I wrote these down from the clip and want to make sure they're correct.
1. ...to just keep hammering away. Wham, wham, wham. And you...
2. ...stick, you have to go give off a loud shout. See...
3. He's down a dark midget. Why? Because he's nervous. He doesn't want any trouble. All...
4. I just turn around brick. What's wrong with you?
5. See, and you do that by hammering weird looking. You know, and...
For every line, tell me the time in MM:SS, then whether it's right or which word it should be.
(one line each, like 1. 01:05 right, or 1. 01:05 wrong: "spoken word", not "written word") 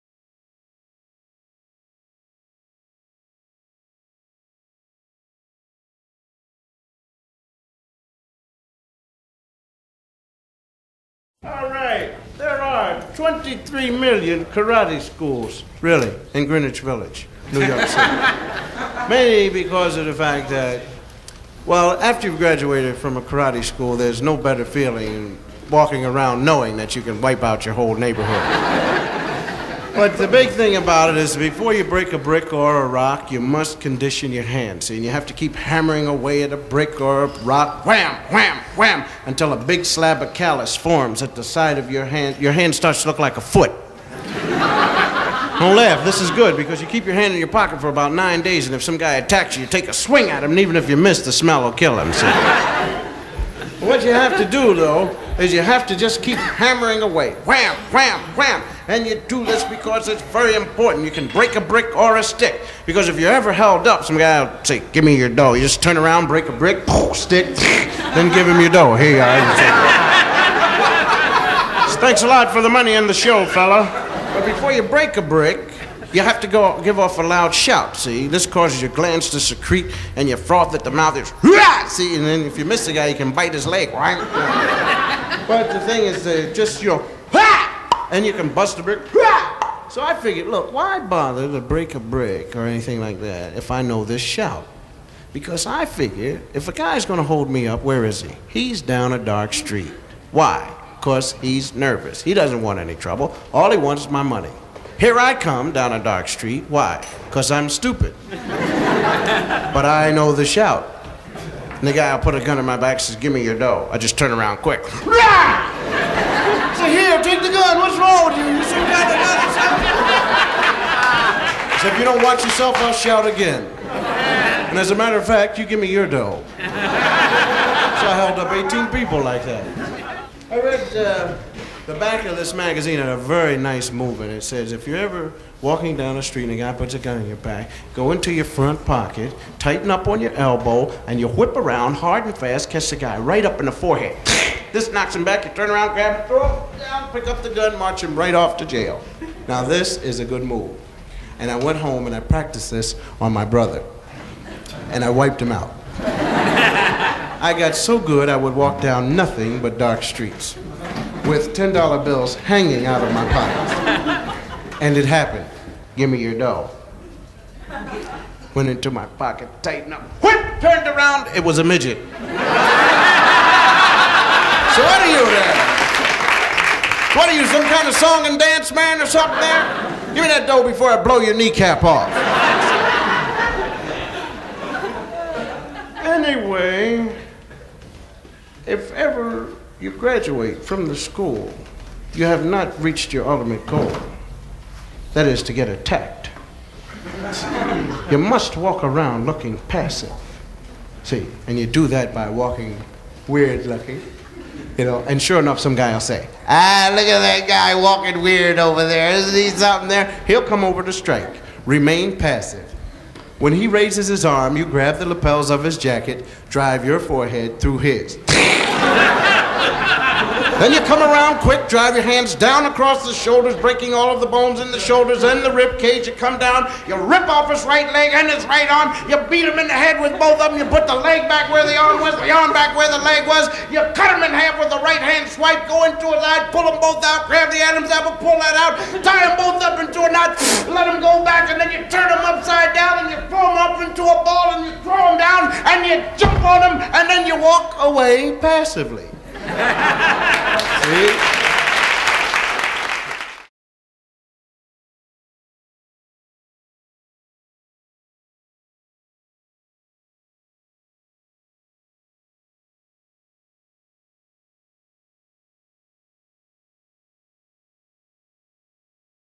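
1. 00:55 right
2. 01:15 wrong: "brick", not "stick"
3. 01:38 wrong: "street", not "midget"
4. 01:53 wrong: "quick", not "brick"
5. 03:21 wrong: "walking", not "hammering".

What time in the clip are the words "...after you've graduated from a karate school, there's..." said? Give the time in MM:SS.
00:21.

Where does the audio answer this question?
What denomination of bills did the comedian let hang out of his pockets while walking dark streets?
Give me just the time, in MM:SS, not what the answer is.
02:41.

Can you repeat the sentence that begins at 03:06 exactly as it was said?
anyway, if ever you graduate from the school, you have not reached your ultimate goal.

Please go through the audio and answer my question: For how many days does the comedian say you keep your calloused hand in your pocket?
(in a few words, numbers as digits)
9.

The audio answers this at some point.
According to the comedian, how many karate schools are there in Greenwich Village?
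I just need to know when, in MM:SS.
00:13.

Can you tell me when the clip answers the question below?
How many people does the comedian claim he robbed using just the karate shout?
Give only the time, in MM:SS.
02:08.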